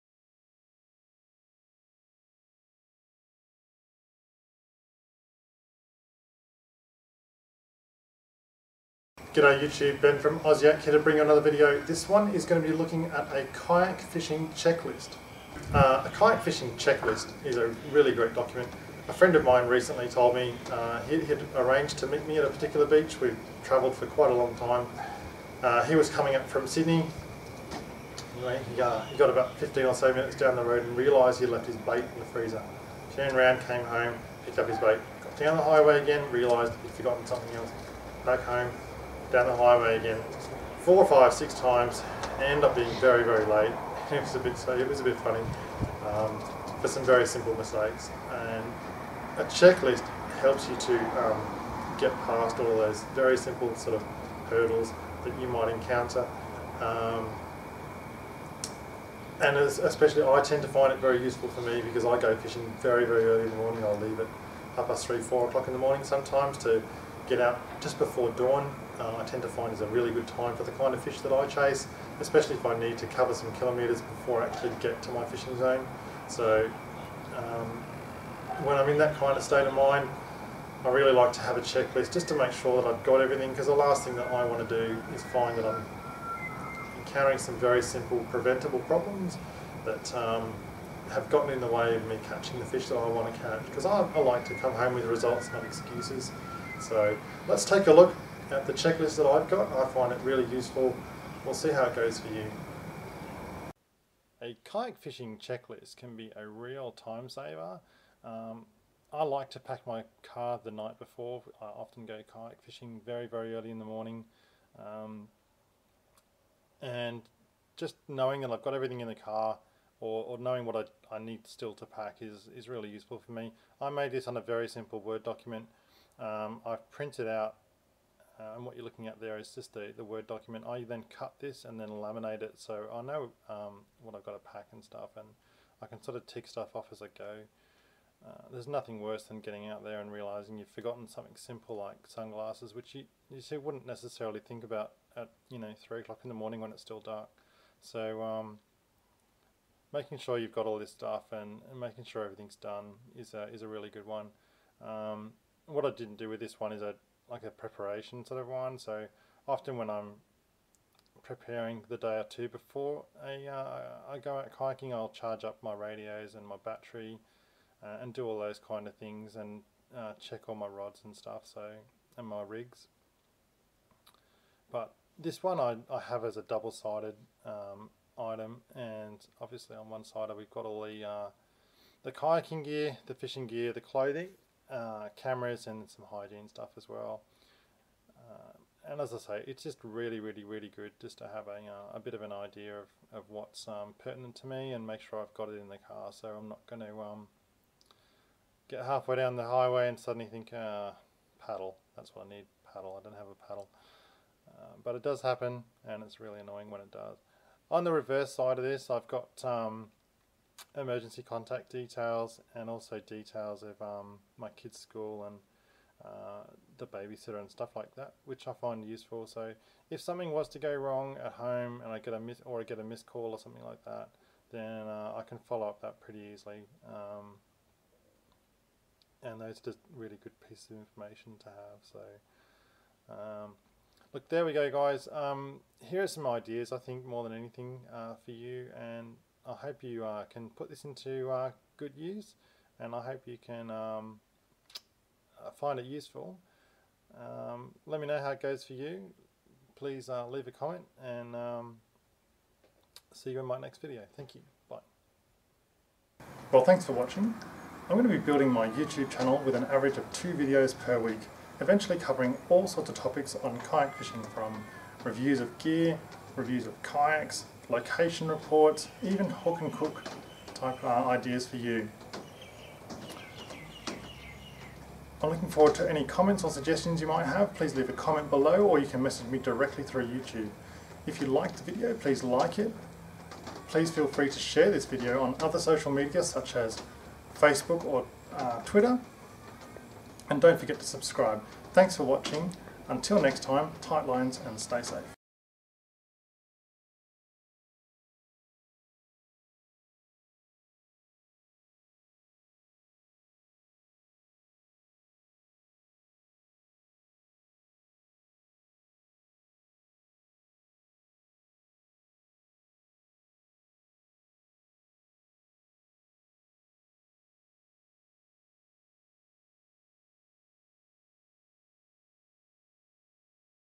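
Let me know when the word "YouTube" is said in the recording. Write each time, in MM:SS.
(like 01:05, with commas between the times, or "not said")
00:09, 04:18, 04:40.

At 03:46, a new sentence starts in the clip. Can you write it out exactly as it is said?
Um, and those are just really good pieces of information to have.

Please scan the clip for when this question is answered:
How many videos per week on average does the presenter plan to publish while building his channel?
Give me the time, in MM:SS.
04:20.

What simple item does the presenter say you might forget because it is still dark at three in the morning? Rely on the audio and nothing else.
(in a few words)
sunglasses.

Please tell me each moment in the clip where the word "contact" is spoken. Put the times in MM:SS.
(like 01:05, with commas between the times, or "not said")
03:31.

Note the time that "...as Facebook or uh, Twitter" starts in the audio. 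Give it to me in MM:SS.
04:46.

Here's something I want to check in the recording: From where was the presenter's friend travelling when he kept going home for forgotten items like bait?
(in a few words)
Sydney.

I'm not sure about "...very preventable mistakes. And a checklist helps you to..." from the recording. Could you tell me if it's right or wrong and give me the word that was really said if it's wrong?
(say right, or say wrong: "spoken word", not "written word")
wrong: "simple", not "preventable".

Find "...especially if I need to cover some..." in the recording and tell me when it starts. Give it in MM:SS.
01:12.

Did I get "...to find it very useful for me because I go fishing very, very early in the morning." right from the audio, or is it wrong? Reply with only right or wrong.
right.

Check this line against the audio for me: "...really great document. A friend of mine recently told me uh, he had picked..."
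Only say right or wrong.
wrong.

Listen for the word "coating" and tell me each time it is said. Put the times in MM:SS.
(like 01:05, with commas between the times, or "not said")
not said.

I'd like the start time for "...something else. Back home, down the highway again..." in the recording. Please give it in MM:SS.
00:37.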